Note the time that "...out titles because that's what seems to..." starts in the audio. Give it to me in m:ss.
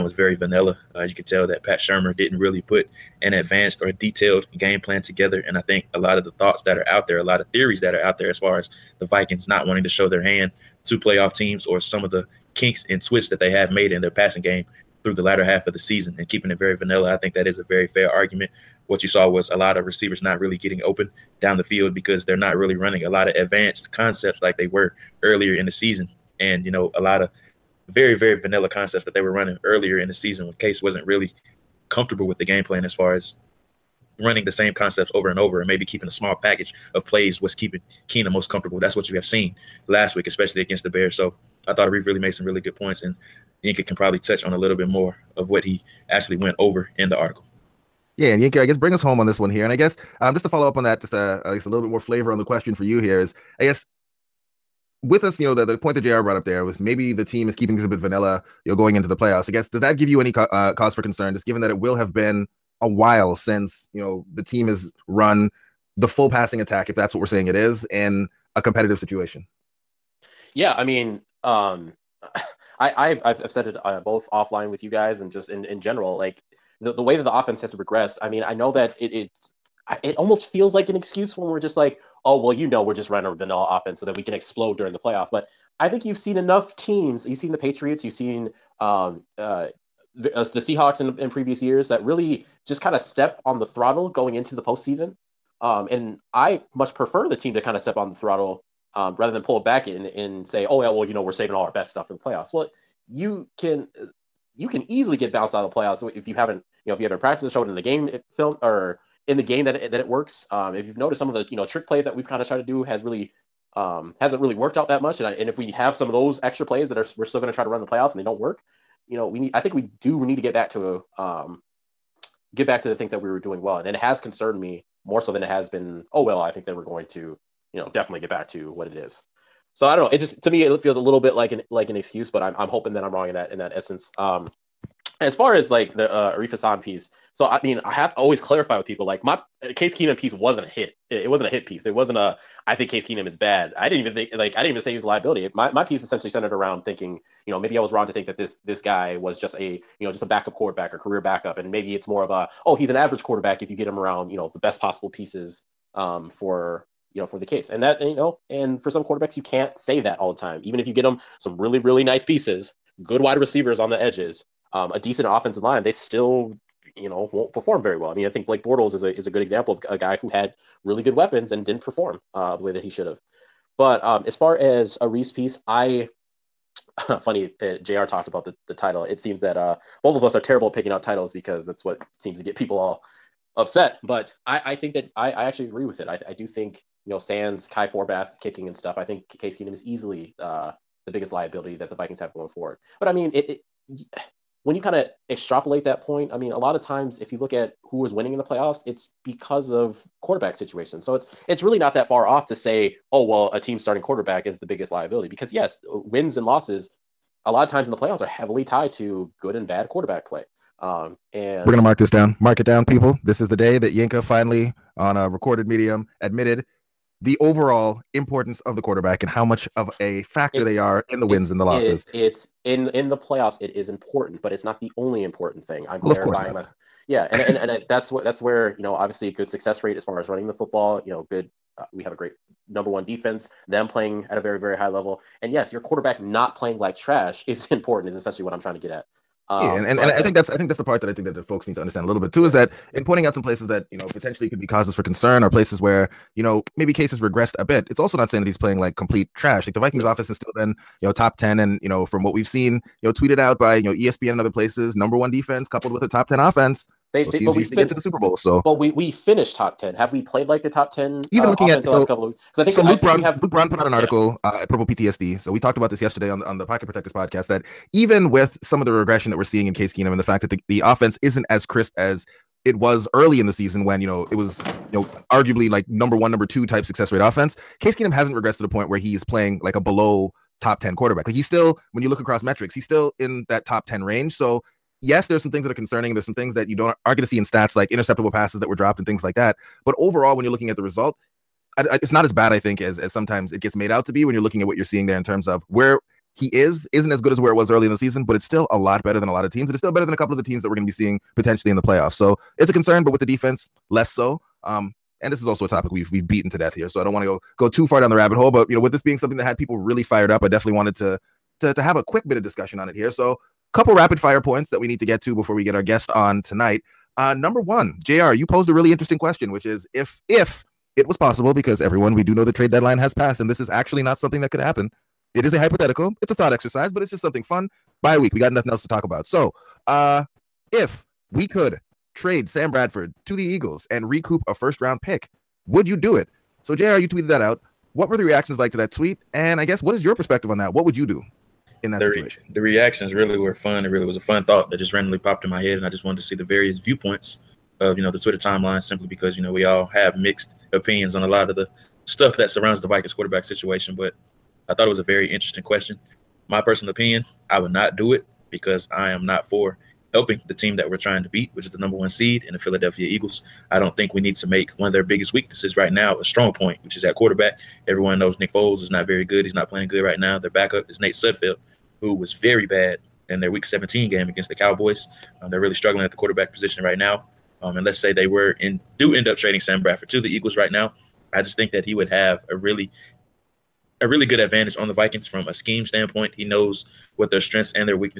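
3:00.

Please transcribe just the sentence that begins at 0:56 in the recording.
brought up there with maybe the team is keeping this a bit vanilla, you know, going into the playoffs.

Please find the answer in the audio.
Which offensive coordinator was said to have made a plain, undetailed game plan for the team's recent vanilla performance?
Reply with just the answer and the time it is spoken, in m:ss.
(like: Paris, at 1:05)
Pat Shurmur, at 0:01.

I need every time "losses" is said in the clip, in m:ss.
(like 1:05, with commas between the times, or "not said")
3:26, 3:41.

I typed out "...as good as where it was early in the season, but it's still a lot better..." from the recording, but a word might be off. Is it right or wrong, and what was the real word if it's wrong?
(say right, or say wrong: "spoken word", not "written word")
right.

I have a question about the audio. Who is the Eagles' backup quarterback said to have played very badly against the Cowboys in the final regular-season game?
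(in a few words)
Nate Sudfeld.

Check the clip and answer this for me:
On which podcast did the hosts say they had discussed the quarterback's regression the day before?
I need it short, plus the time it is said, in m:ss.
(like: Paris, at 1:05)
Pocket Protectors, at 4:26.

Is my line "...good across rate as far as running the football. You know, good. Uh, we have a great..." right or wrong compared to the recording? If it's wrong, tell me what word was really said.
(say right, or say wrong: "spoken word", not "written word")
wrong: "success", not "across".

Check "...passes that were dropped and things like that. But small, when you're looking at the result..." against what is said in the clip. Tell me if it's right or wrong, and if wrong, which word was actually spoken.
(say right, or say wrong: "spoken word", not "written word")
wrong: "overall", not "small".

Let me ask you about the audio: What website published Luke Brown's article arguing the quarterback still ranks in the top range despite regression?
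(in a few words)
Purple PTSD.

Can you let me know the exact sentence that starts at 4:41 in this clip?
Like he's still, when you look across metrics, he's still in that top 10 range.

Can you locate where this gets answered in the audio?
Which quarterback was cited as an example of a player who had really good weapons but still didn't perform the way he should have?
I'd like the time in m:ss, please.
2:48.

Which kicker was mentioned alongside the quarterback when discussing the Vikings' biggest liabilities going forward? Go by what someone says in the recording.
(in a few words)
Kai Forbath.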